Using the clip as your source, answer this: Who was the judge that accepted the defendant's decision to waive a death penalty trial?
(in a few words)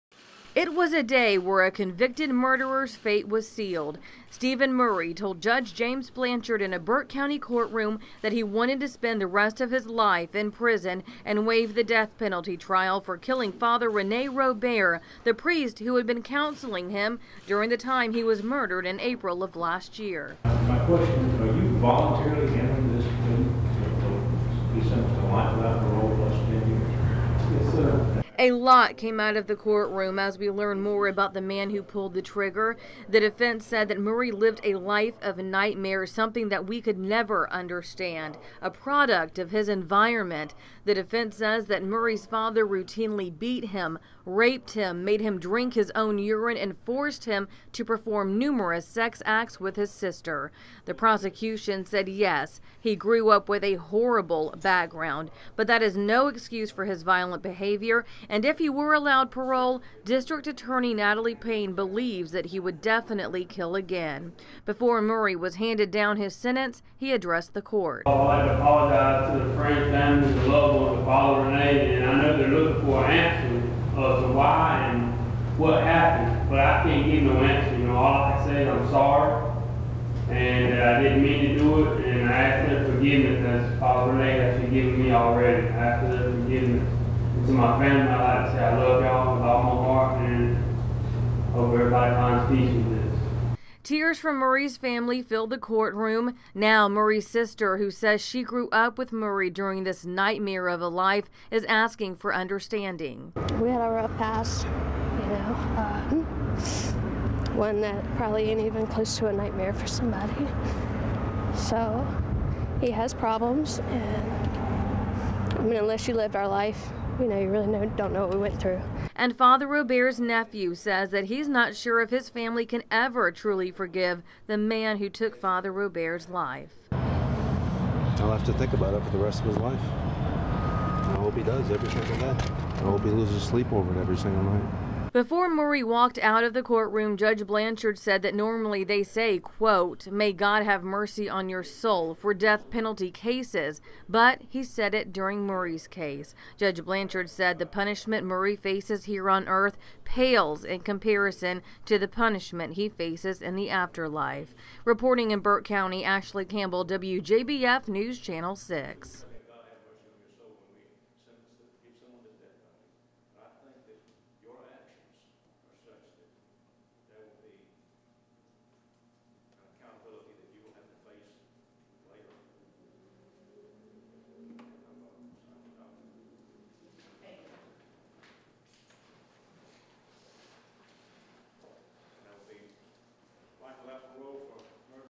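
James Blanchard.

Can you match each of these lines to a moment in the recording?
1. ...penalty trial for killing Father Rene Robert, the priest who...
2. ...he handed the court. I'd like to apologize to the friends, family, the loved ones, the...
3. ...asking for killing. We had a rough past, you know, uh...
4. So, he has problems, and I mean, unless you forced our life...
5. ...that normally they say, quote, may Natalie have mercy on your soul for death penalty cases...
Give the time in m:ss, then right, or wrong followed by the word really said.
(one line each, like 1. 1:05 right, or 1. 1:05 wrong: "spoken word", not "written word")
1. 0:12 right
2. 1:06 wrong: "addressed", not "handed"
3. 1:41 wrong: "understanding", not "killing"
4. 1:51 wrong: "lived", not "forced"
5. 2:18 wrong: "God", not "Natalie".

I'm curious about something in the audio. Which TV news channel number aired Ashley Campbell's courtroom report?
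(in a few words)
6.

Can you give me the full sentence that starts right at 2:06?
I'll have to think about it for the rest of his life.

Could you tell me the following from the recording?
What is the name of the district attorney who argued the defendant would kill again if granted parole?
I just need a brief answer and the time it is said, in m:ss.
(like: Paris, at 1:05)
Natalie Paine, at 1:00.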